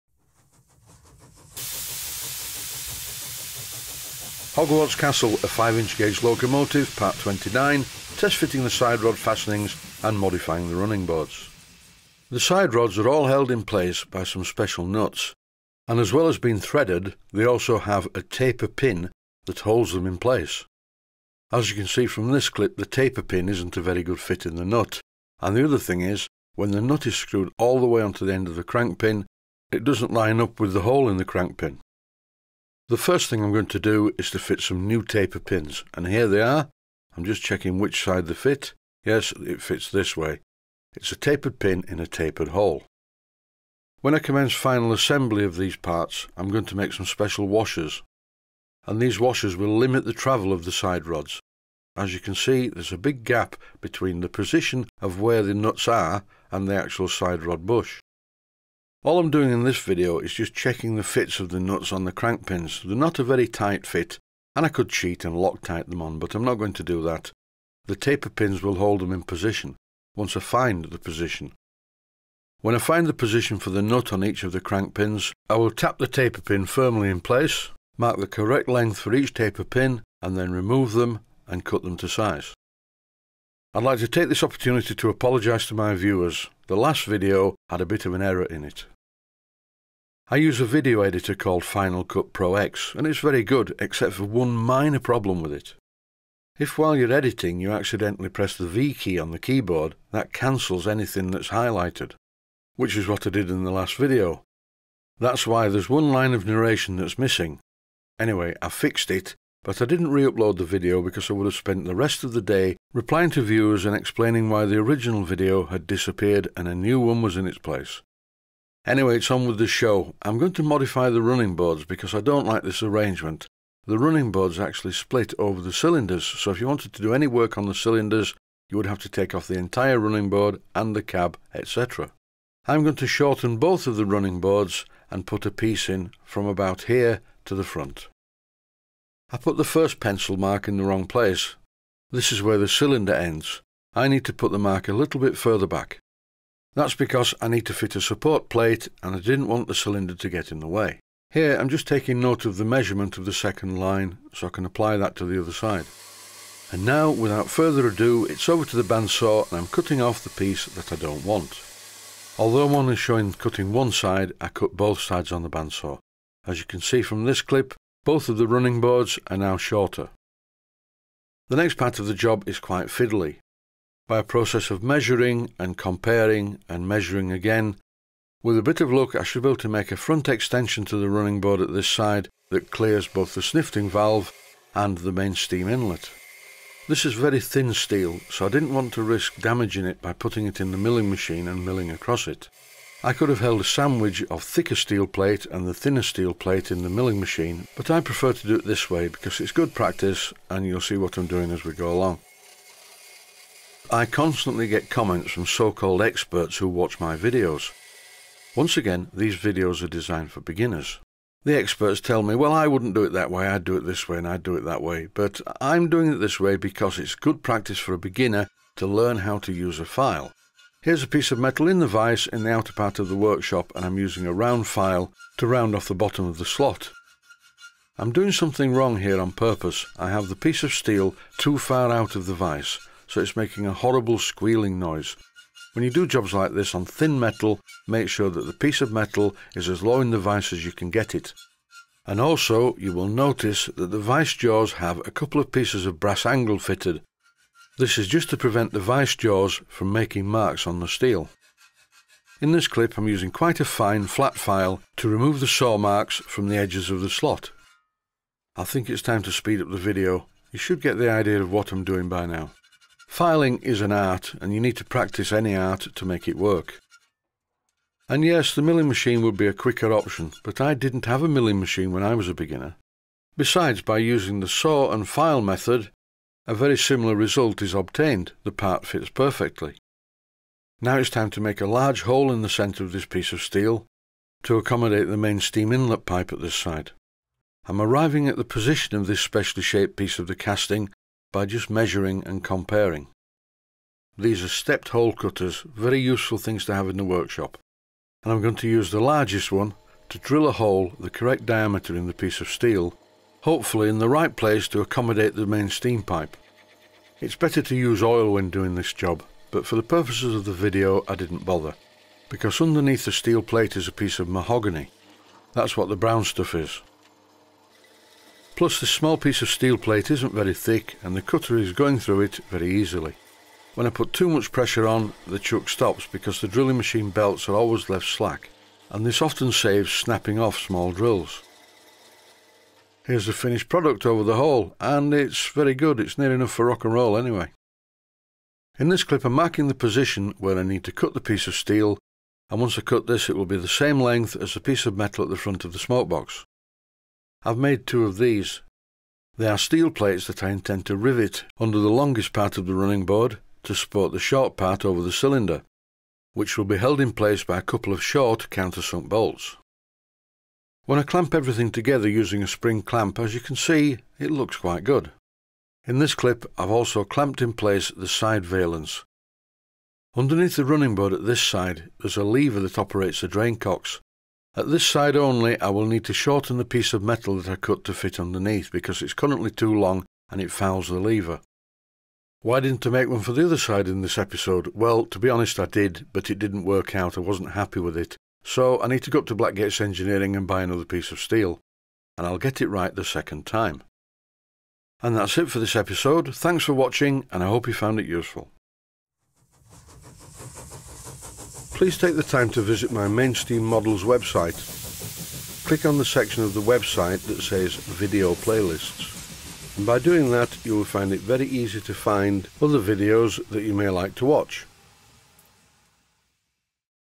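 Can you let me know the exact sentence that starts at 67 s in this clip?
The taper pins will hold them in position once I find the position.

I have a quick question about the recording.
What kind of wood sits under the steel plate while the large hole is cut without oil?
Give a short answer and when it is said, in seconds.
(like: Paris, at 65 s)
Mahogany, at 314 s.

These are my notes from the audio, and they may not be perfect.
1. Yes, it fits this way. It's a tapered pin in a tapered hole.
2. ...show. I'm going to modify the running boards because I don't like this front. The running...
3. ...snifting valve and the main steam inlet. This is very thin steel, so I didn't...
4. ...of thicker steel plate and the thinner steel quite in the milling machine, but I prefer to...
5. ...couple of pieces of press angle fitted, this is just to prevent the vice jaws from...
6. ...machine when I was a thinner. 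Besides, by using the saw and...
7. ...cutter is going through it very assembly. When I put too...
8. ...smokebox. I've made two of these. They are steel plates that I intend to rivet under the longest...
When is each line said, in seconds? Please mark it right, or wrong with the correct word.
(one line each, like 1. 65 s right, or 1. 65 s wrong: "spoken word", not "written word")
1. 39 s right
2. 119 s wrong: "arrangement", not "front"
3. 183 s right
4. 194 s wrong: "plate", not "quite"
5. 245 s wrong: "brass", not "press"
6. 271 s wrong: "beginner", not "thinner"
7. 321 s wrong: "easily", not "assembly"
8. 345 s right.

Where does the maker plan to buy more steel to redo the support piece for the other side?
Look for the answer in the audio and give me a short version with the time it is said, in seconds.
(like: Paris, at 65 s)
Blackgate's engineering, at 389 s.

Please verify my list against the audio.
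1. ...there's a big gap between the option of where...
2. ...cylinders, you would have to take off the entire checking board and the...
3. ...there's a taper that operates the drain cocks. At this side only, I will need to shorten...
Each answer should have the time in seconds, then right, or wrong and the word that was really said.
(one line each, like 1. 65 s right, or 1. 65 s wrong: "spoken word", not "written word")
1. 52 s wrong: "position", not "option"
2. 127 s wrong: "running", not "checking"
3. 371 s wrong: "lever", not "taper".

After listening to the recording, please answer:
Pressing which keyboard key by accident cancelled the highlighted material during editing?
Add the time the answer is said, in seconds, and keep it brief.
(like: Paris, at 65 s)
V, at 98 s.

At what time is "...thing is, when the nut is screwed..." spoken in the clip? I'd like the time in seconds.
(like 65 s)
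25 s.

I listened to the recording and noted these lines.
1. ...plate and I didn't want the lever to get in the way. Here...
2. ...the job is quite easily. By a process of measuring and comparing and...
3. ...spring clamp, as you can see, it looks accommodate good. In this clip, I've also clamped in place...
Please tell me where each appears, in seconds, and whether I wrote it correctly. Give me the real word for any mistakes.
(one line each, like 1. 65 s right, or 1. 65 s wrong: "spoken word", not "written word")
1. 148 s wrong: "cylinder", not "lever"
2. 172 s wrong: "fiddly", not "easily"
3. 362 s wrong: "quite", not "accommodate".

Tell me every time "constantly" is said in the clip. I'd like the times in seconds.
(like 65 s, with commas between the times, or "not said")
204 s.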